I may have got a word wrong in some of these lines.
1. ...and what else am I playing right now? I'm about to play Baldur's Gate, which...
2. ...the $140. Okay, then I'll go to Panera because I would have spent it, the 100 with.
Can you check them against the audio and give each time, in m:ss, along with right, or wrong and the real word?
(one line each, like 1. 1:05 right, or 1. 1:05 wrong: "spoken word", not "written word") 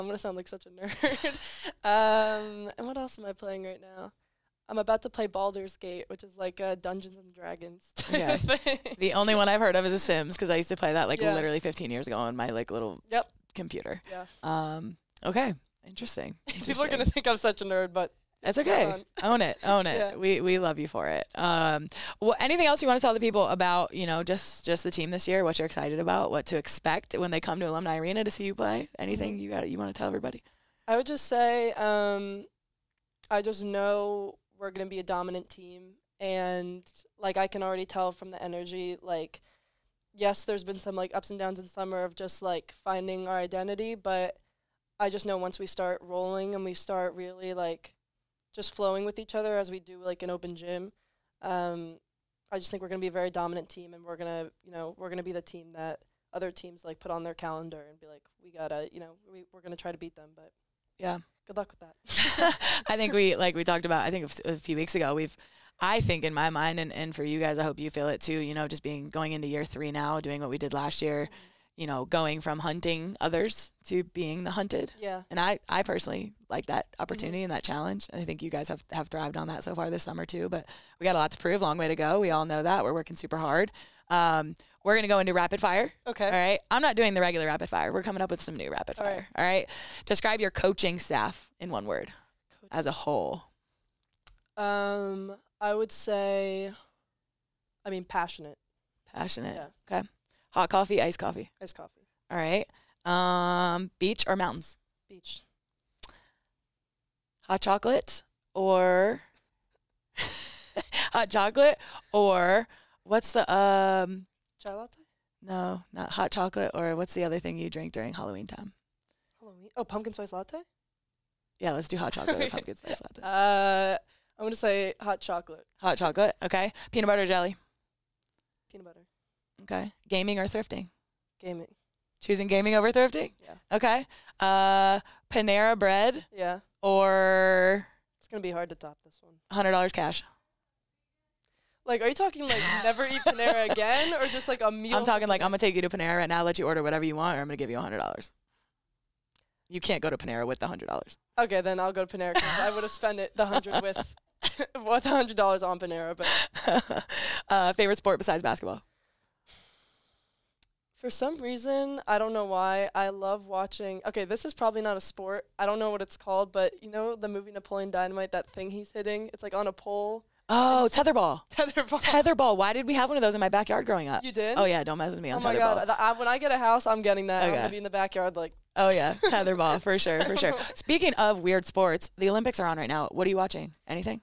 1. 0:02 right
2. 2:30 wrong: "100", not "140".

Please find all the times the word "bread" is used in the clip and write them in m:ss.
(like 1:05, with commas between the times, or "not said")
2:15.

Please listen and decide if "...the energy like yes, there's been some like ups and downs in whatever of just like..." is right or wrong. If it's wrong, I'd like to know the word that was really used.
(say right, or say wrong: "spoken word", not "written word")
wrong: "summer", not "whatever".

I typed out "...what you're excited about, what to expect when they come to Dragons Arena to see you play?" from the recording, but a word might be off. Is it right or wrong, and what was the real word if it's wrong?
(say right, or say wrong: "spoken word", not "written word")
wrong: "Alumni", not "Dragons".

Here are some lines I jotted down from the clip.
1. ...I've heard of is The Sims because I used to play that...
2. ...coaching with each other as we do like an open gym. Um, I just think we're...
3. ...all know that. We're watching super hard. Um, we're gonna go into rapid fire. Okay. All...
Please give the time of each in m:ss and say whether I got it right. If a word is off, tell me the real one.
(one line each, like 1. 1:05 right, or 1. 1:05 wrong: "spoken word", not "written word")
1. 0:09 right
2. 0:48 wrong: "flowing", not "coaching"
3. 1:22 wrong: "working", not "watching".